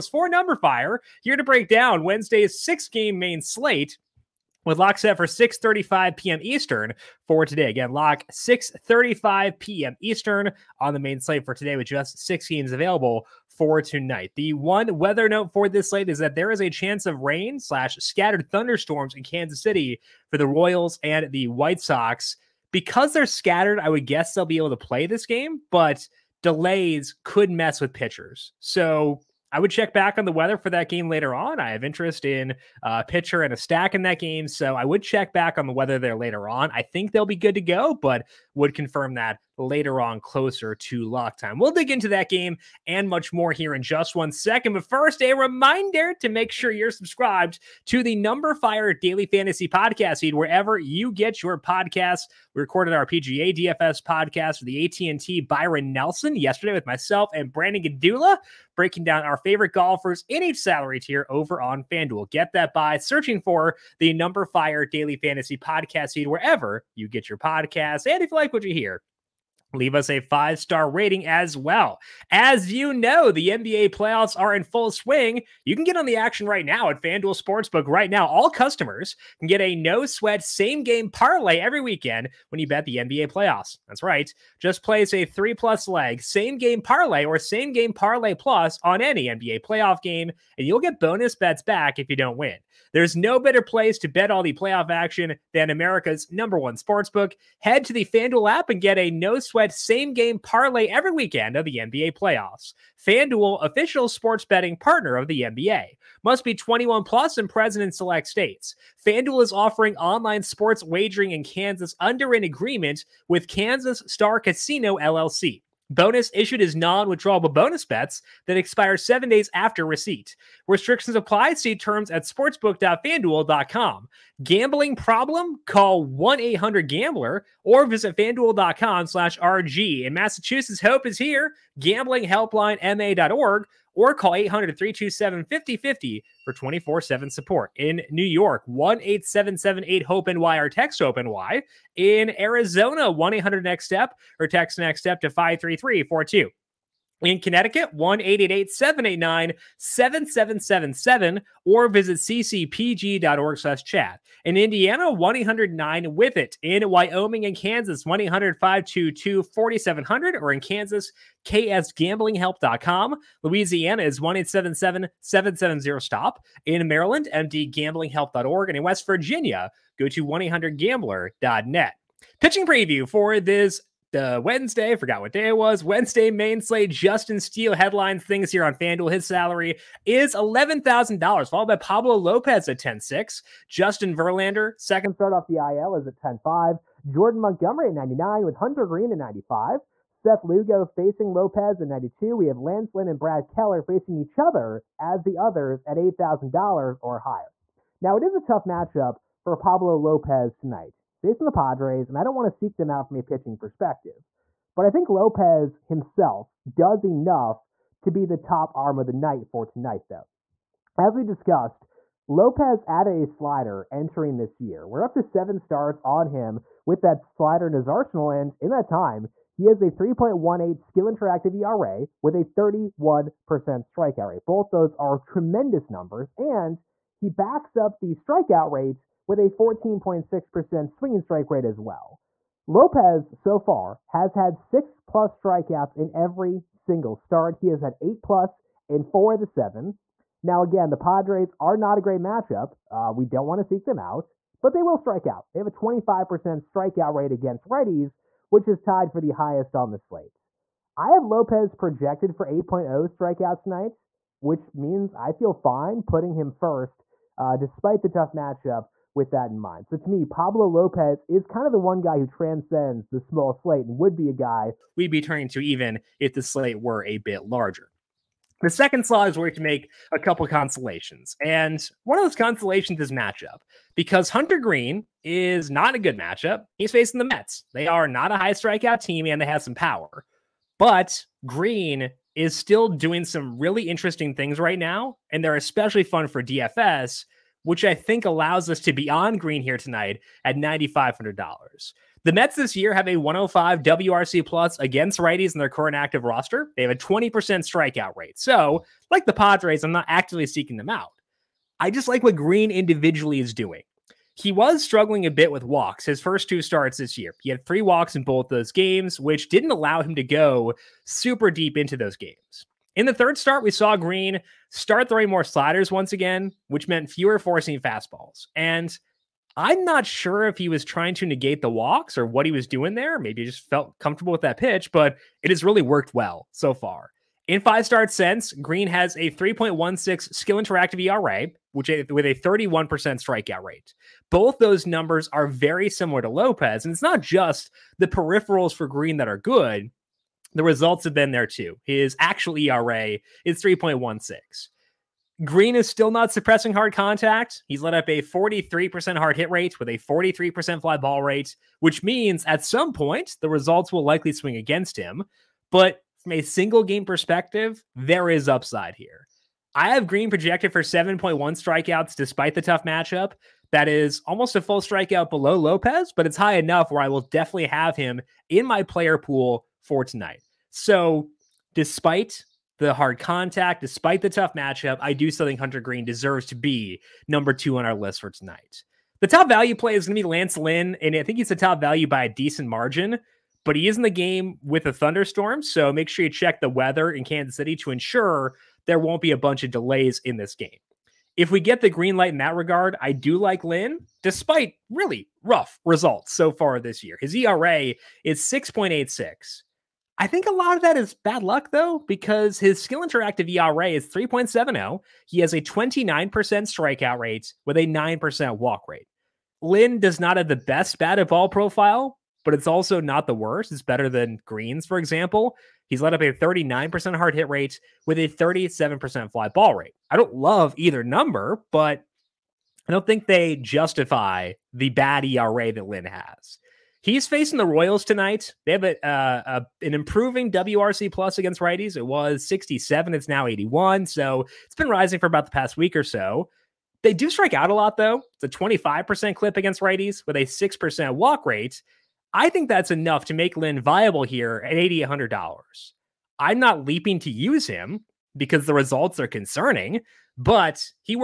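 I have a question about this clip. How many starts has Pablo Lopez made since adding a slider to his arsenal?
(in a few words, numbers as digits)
7.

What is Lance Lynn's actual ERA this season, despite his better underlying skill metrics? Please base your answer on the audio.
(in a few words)
6.86.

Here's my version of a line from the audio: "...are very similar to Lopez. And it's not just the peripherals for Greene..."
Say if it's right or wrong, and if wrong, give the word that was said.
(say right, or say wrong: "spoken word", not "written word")
right.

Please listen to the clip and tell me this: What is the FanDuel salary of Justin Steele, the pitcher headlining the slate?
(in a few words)
$11,000.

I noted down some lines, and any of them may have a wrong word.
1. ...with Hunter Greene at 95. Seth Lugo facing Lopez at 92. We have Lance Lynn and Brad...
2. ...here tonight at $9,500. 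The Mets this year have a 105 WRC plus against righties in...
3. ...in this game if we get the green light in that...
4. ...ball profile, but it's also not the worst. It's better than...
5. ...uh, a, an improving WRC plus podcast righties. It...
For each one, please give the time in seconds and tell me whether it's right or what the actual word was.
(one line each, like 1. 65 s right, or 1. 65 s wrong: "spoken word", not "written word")
1. 188 s right
2. 289 s right
3. 390 s right
4. 411 s right
5. 429 s wrong: "against", not "podcast".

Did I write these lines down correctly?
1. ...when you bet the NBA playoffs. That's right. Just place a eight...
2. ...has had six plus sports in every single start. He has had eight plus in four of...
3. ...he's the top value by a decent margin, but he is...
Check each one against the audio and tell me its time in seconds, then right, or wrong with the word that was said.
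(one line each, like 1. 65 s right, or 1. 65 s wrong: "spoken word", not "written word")
1. 82 s wrong: "three", not "eight"
2. 234 s wrong: "strikeouts", not "sports"
3. 381 s right.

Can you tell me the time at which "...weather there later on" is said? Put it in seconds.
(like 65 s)
35 s.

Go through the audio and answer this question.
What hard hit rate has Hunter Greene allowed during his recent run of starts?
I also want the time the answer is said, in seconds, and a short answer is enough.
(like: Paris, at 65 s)
43%, at 348 s.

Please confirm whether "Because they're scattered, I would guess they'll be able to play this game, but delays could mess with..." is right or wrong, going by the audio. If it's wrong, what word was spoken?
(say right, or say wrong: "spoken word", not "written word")
right.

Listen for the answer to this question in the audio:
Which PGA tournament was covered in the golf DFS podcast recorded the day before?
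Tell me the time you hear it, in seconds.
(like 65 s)
54 s.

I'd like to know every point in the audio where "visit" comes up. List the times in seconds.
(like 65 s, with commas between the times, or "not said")
127 s, 151 s.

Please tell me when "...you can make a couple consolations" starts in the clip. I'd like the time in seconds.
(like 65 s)
269 s.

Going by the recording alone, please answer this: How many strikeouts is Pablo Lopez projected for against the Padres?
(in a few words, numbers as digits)
8.0.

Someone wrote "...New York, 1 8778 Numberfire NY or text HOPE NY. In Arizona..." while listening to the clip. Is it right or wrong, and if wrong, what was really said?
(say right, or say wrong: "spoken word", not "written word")
wrong: "HOPE", not "Numberfire".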